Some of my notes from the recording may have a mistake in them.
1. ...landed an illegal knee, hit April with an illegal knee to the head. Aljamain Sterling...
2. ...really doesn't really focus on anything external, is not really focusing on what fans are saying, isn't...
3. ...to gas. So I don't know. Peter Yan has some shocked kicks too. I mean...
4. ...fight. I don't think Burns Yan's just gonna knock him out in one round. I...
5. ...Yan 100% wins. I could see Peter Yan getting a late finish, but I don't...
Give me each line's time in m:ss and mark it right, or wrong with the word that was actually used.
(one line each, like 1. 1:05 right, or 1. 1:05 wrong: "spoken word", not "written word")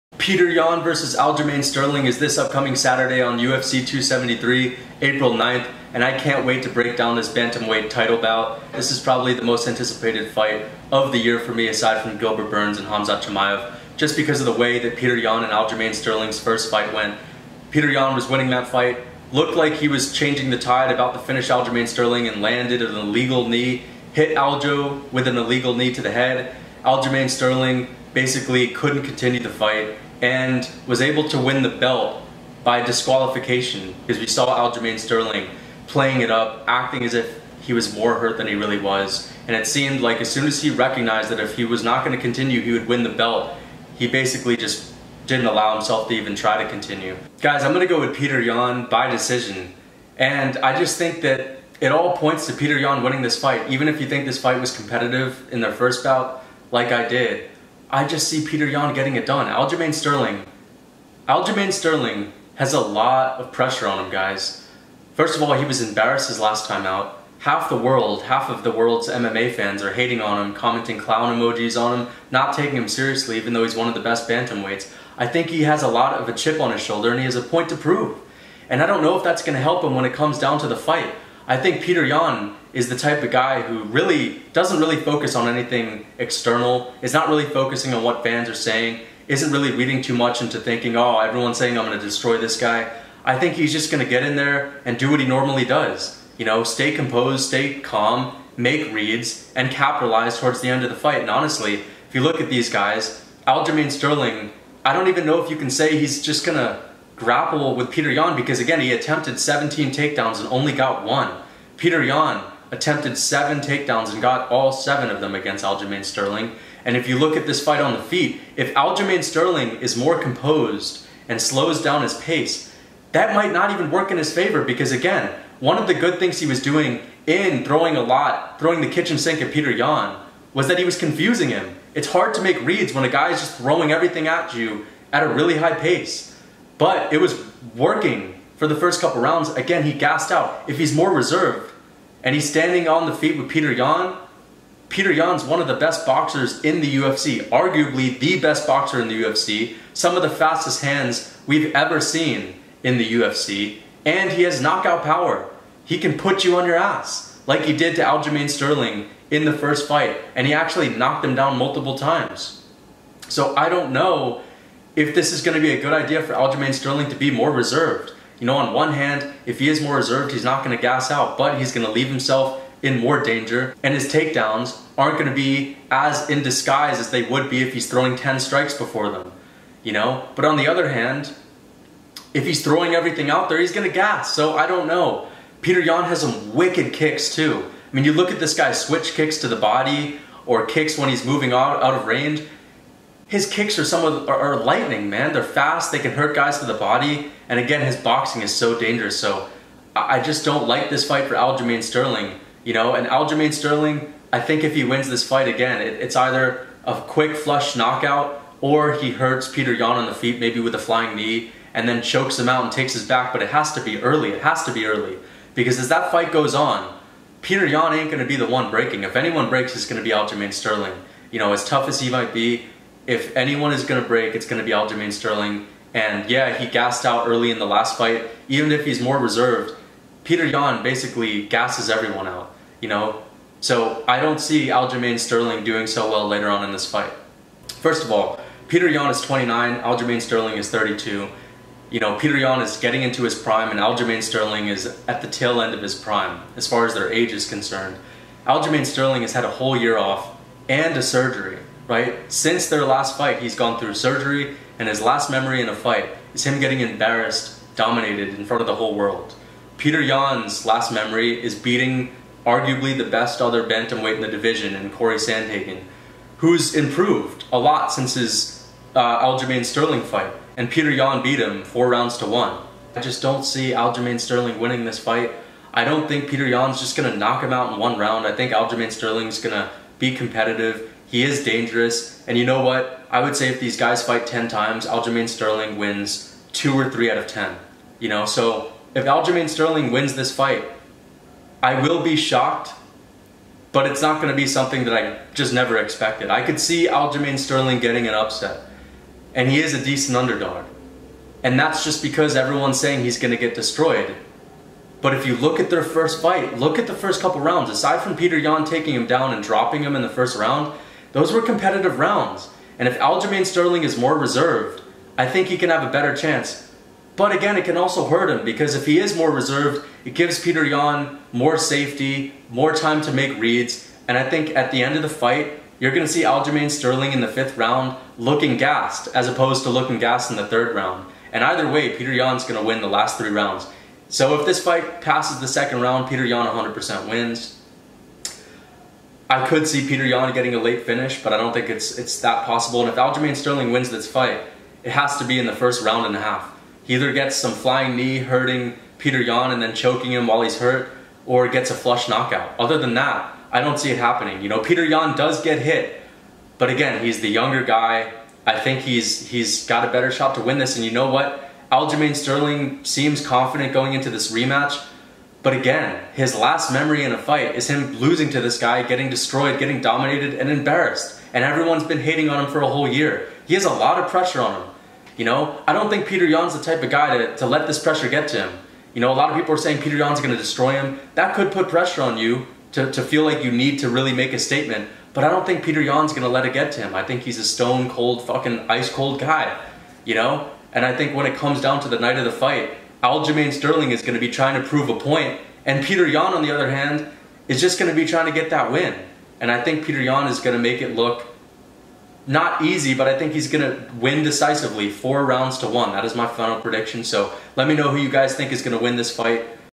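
1. 0:22 wrong: "Aljo", not "April"
2. 1:23 right
3. 3:03 wrong: "wicked", not "shocked"
4. 4:34 wrong: "Peter", not "Burns"
5. 5:36 right.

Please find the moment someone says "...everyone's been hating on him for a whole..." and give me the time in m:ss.
6:11.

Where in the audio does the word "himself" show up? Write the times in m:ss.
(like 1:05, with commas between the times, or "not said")
0:45, 2:52.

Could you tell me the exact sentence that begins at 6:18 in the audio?
You know, a lot of people are saying Peter Yan's going to destroy him.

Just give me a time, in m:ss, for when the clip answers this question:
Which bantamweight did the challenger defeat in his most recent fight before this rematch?
4:24.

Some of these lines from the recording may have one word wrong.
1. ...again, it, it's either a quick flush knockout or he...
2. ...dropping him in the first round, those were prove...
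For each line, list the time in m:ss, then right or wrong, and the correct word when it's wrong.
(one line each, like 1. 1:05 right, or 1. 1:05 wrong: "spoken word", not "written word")
1. 3:25 right
2. 5:09 wrong: "competitive", not "prove".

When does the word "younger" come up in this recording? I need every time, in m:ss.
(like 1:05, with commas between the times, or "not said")
5:57.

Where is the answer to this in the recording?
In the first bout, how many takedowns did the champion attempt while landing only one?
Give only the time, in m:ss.
1:49.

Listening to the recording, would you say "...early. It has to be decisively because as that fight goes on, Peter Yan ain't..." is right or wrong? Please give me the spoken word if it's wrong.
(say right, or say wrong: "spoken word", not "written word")
wrong: "early", not "decisively".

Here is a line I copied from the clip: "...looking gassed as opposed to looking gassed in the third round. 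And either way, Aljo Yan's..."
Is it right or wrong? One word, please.
wrong.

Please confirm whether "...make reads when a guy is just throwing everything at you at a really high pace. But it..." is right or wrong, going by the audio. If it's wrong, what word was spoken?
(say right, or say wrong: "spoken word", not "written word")
right.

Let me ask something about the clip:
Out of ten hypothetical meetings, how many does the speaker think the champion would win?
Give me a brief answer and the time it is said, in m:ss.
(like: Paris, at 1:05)
2 or 3, at 4:46.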